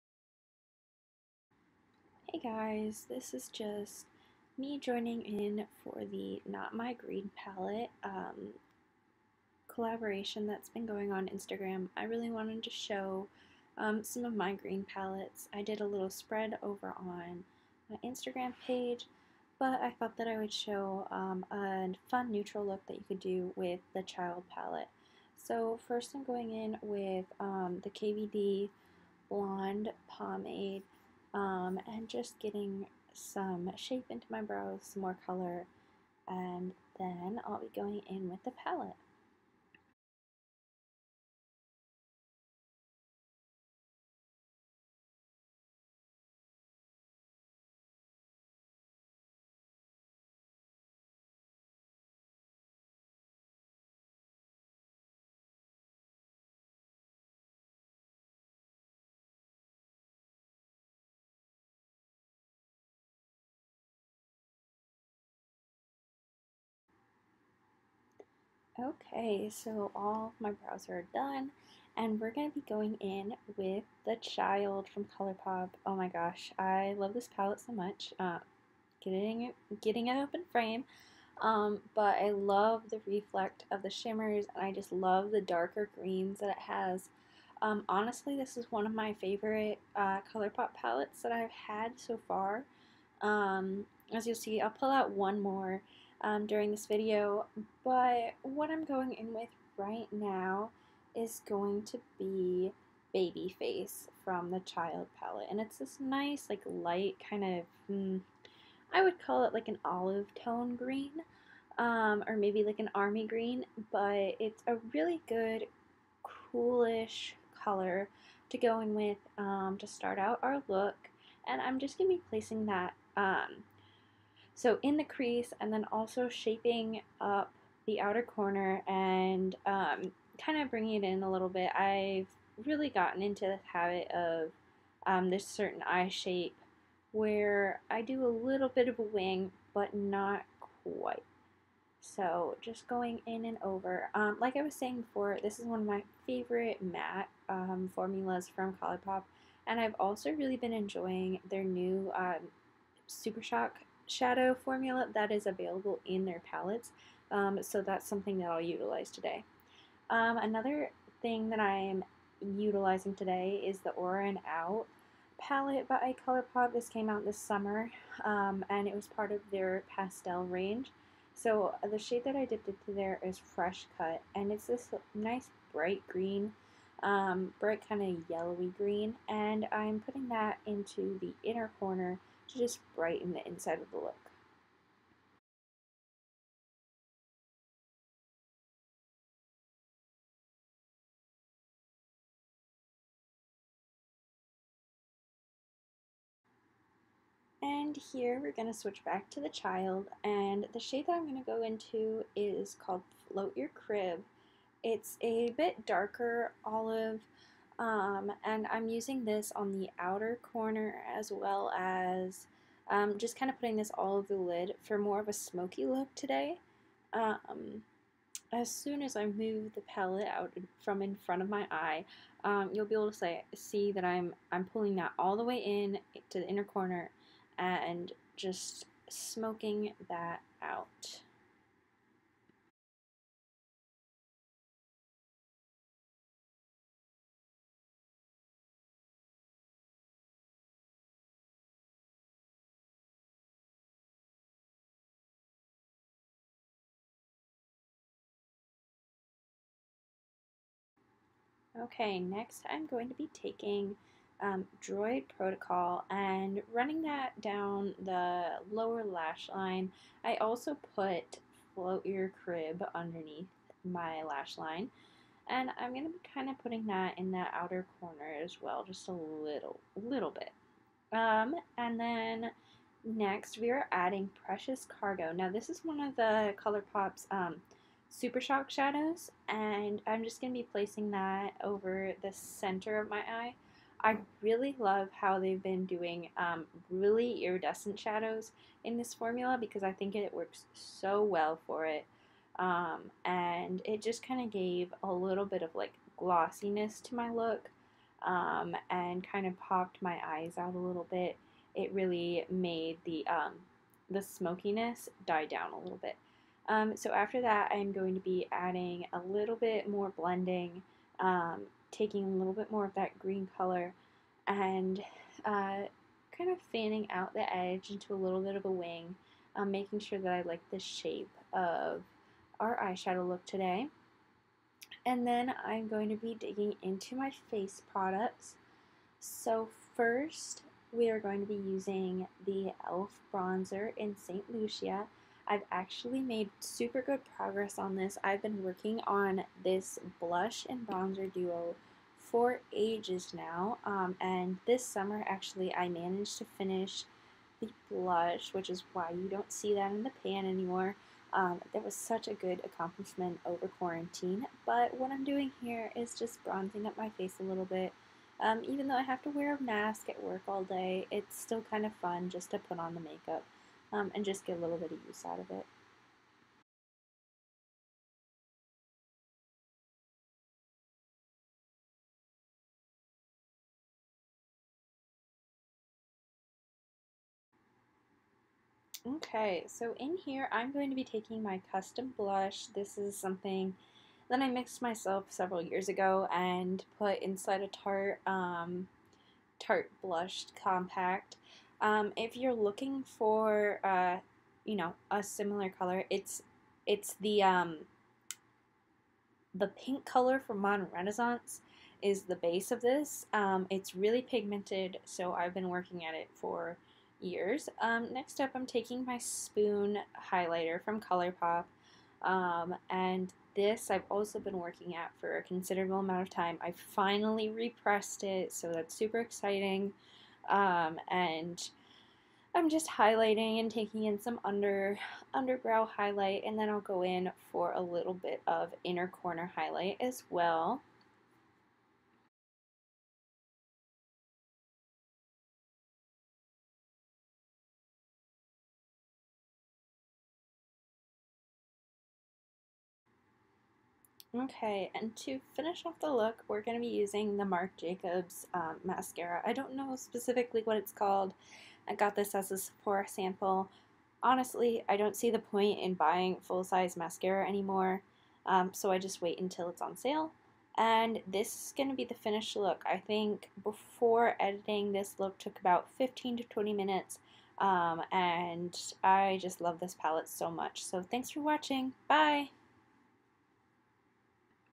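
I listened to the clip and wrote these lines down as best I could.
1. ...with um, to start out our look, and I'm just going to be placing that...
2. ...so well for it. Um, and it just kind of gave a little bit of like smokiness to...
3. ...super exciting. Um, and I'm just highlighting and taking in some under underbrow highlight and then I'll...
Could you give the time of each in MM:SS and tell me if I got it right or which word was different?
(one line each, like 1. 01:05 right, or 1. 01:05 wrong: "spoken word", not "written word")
1. 01:58 right
2. 04:50 wrong: "glossiness", not "smokiness"
3. 06:58 right.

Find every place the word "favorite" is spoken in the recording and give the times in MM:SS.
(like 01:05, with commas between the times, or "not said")
01:29, 02:26.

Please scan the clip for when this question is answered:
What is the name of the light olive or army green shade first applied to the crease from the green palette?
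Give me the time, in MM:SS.
01:43.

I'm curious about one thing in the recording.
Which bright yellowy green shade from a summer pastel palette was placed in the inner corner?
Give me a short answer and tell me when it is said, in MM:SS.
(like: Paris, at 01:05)
Fresh Cut, at 02:53.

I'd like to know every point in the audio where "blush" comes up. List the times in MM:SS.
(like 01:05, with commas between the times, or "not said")
05:40, 05:47, 06:22, 06:30.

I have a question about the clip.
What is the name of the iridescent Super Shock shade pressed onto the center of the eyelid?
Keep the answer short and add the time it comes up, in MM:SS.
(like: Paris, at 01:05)
Precious Cargo, at 04:34.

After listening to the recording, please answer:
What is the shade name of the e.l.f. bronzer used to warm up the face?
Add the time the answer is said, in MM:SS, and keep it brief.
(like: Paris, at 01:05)
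St. Lucia, at 05:34.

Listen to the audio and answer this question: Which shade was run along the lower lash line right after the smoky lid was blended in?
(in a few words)
Droid Protocol.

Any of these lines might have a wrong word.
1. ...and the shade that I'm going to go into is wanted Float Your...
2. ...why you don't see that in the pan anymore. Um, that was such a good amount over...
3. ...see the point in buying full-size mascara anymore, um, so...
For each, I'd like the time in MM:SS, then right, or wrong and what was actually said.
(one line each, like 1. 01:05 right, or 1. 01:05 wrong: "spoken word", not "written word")
1. 03:20 wrong: "called", not "wanted"
2. 05:48 wrong: "accomplishment", not "amount"
3. 07:35 right.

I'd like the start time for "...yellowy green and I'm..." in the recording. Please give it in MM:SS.
02:58.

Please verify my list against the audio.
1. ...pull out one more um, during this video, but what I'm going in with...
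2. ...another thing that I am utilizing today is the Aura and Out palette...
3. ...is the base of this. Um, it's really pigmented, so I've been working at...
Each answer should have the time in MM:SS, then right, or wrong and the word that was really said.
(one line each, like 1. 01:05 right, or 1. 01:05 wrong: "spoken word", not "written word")
1. 01:34 right
2. 02:40 right
3. 06:42 right.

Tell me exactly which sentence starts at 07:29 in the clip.
I don't know specifically what it's called.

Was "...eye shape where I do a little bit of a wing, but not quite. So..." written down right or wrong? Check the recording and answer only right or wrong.
right.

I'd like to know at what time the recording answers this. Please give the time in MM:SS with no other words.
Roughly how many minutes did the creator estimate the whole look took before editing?
07:45.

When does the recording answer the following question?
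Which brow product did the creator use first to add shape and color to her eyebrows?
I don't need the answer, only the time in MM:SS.
00:27.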